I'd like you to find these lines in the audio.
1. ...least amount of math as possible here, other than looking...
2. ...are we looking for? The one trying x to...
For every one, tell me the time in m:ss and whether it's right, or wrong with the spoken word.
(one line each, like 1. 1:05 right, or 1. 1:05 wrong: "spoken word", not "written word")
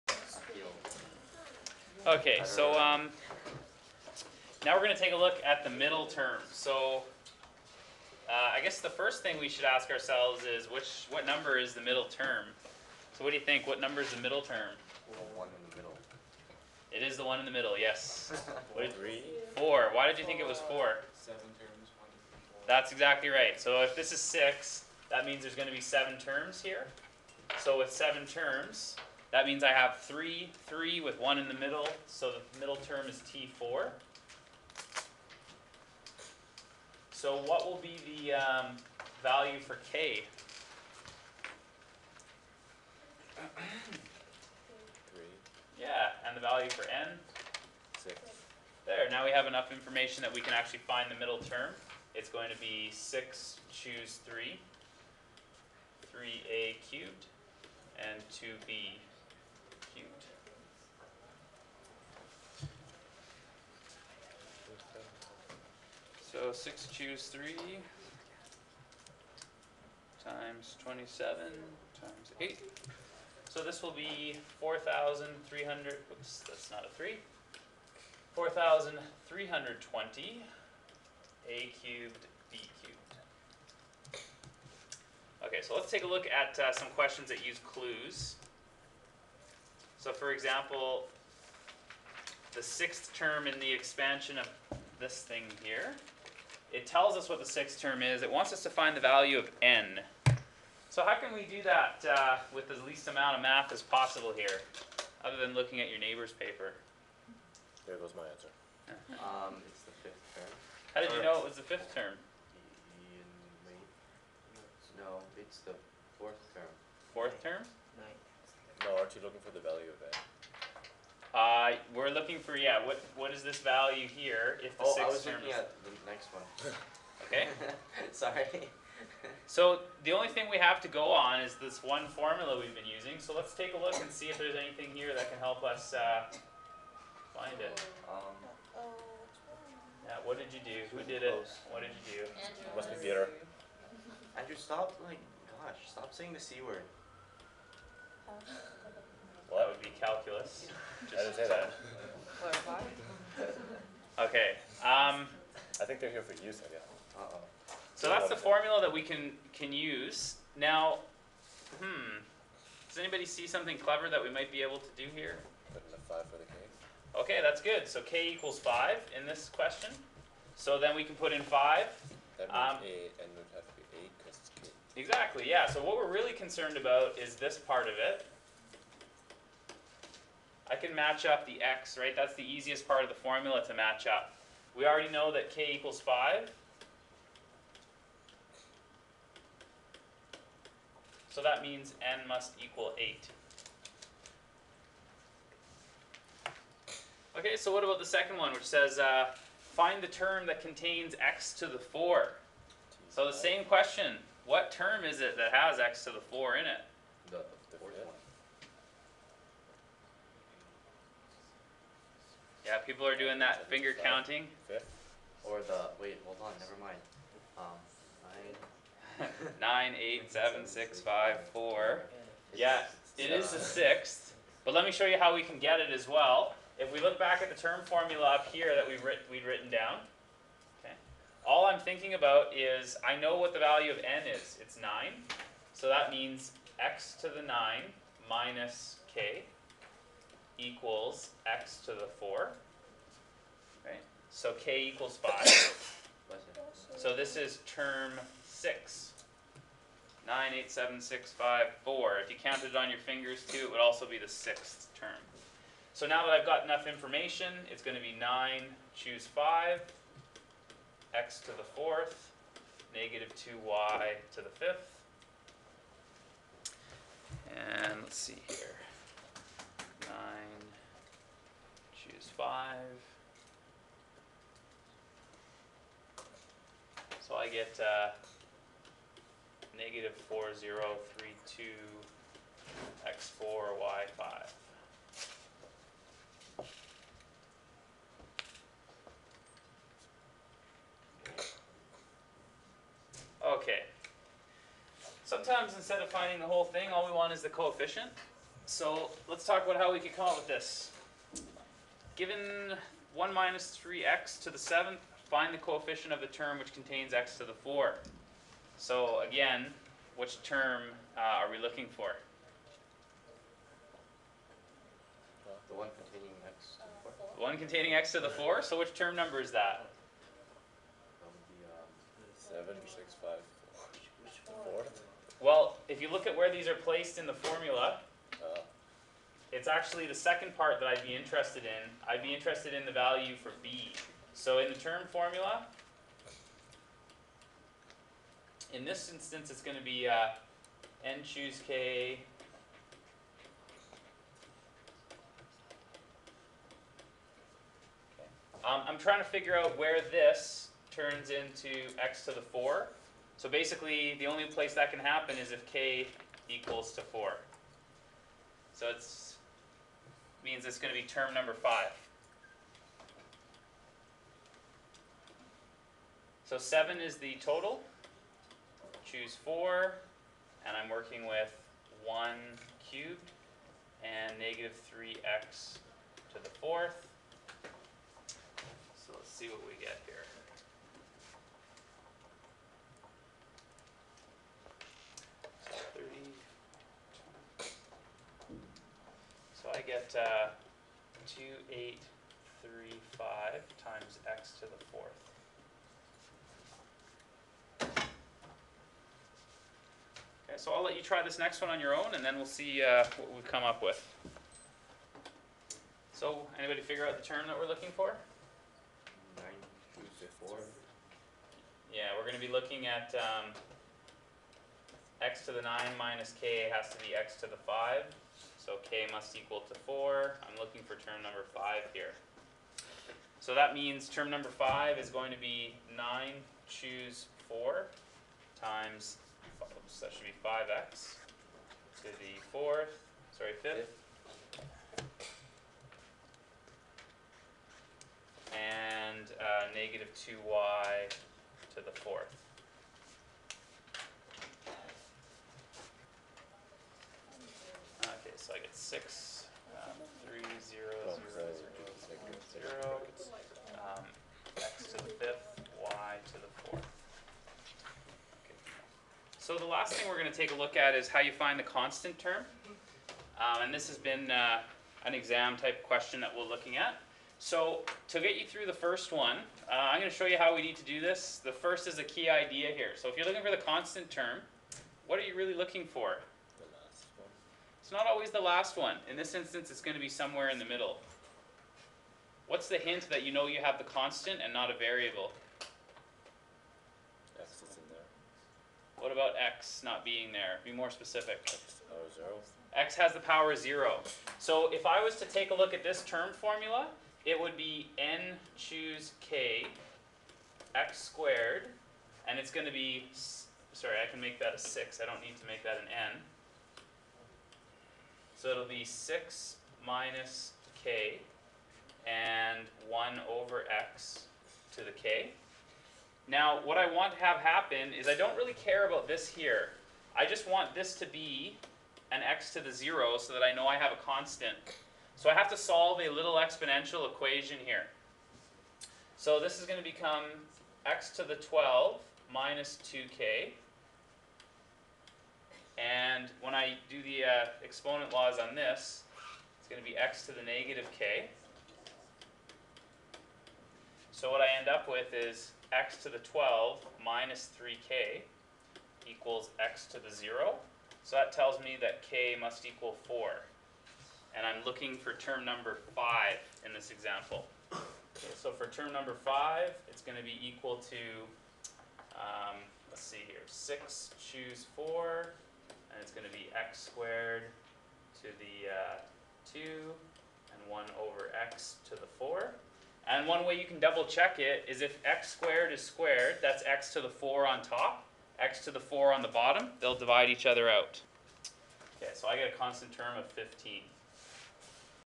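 1. 1:42 right
2. 5:11 wrong: "containing", not "trying".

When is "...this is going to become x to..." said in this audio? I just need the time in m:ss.
8:49.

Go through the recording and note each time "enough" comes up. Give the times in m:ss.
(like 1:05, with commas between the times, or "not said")
0:49, 4:16.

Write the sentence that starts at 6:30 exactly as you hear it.
Uh, 8, 3, 2835 times x to the fourth.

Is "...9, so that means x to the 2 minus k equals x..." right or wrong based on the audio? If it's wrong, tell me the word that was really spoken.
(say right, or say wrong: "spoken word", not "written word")
wrong: "9", not "2".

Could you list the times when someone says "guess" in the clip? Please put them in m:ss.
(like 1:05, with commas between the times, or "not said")
0:08, 2:36.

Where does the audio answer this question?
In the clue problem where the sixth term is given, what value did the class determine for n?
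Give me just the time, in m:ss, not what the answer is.
3:12.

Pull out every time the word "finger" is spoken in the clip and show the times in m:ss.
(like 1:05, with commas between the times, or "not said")
3:33, 4:12.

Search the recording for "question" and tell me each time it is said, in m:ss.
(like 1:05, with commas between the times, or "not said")
1:26, 2:49, 3:23, 7:45.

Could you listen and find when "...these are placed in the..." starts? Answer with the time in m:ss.
5:26.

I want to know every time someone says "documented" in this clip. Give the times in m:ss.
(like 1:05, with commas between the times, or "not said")
not said.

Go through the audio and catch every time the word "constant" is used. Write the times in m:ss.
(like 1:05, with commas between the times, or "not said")
7:41, 7:53, 8:03, 8:44, 9:42.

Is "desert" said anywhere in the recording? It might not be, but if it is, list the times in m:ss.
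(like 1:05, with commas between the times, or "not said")
not said.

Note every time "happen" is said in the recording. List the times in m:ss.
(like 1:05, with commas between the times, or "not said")
5:54, 8:37.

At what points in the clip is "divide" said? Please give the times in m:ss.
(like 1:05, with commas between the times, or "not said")
9:39.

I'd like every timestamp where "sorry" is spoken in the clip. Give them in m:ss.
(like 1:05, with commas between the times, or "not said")
2:08, 7:13, 8:23.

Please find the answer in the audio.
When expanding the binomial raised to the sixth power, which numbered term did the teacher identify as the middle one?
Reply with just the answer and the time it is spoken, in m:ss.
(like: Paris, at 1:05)
T4, at 0:33.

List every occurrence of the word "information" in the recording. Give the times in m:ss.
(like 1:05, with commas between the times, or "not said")
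0:49, 4:16.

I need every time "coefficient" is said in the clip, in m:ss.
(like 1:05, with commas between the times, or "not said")
4:57, 5:05.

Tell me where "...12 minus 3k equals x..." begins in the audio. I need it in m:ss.
9:06.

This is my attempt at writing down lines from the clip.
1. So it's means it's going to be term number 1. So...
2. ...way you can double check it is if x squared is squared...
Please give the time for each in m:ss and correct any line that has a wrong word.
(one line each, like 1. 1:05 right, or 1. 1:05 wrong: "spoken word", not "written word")
1. 5:58 wrong: "5", not "1"
2. 9:33 right.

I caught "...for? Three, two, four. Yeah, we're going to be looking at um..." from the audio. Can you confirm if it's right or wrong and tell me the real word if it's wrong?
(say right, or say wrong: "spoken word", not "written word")
wrong: "Nine", not "Three".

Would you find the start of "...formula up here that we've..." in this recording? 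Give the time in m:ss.
3:47.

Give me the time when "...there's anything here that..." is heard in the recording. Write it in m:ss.
2:14.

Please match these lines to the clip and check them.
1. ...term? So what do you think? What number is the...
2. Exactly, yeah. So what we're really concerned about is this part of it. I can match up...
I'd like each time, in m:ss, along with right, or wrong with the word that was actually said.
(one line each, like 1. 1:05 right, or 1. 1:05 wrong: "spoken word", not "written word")
1. 0:12 right
2. 2:55 right.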